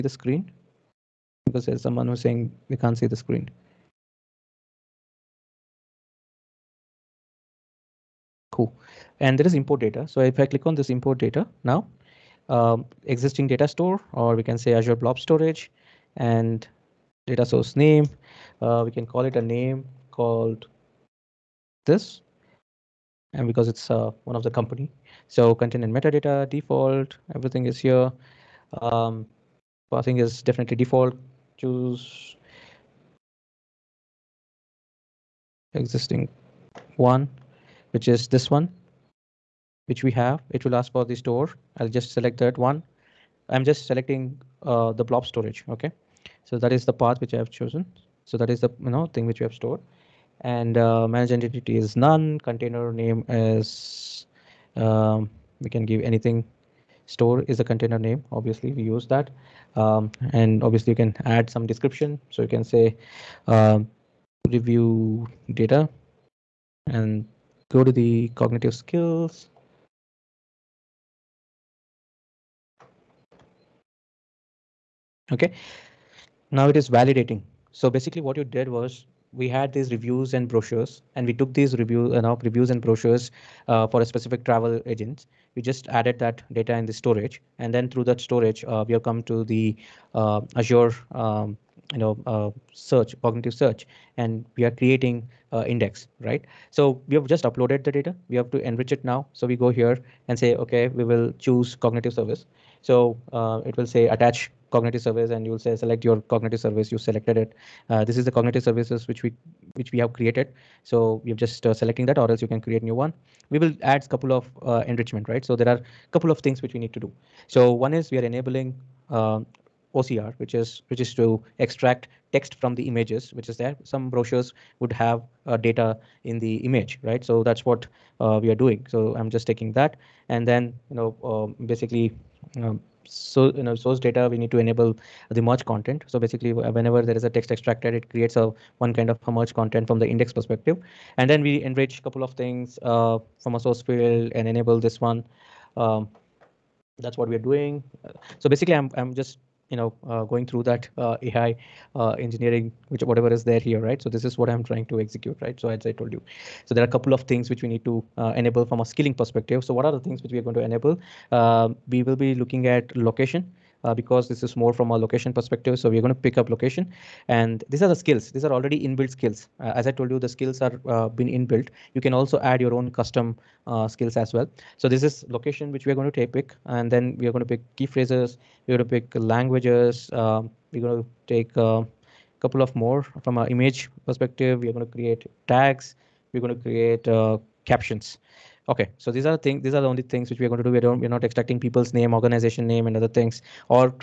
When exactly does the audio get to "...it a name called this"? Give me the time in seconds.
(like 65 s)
19 s.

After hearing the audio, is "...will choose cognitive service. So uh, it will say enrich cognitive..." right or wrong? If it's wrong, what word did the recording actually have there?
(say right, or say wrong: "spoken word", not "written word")
wrong: "attach", not "enrich".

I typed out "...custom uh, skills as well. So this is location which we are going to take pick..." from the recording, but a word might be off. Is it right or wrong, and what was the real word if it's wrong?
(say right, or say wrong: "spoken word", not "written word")
right.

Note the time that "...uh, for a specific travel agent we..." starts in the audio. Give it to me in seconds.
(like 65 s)
83 s.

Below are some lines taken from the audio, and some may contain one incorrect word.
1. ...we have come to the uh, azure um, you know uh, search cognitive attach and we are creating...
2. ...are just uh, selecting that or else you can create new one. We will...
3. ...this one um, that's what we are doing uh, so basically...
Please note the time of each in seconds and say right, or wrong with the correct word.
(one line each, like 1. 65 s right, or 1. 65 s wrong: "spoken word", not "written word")
1. 88 s wrong: "search", not "attach"
2. 111 s right
3. 144 s right.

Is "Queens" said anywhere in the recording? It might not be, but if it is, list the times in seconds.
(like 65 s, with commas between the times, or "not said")
not said.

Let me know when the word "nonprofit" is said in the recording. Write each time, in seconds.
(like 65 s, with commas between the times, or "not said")
not said.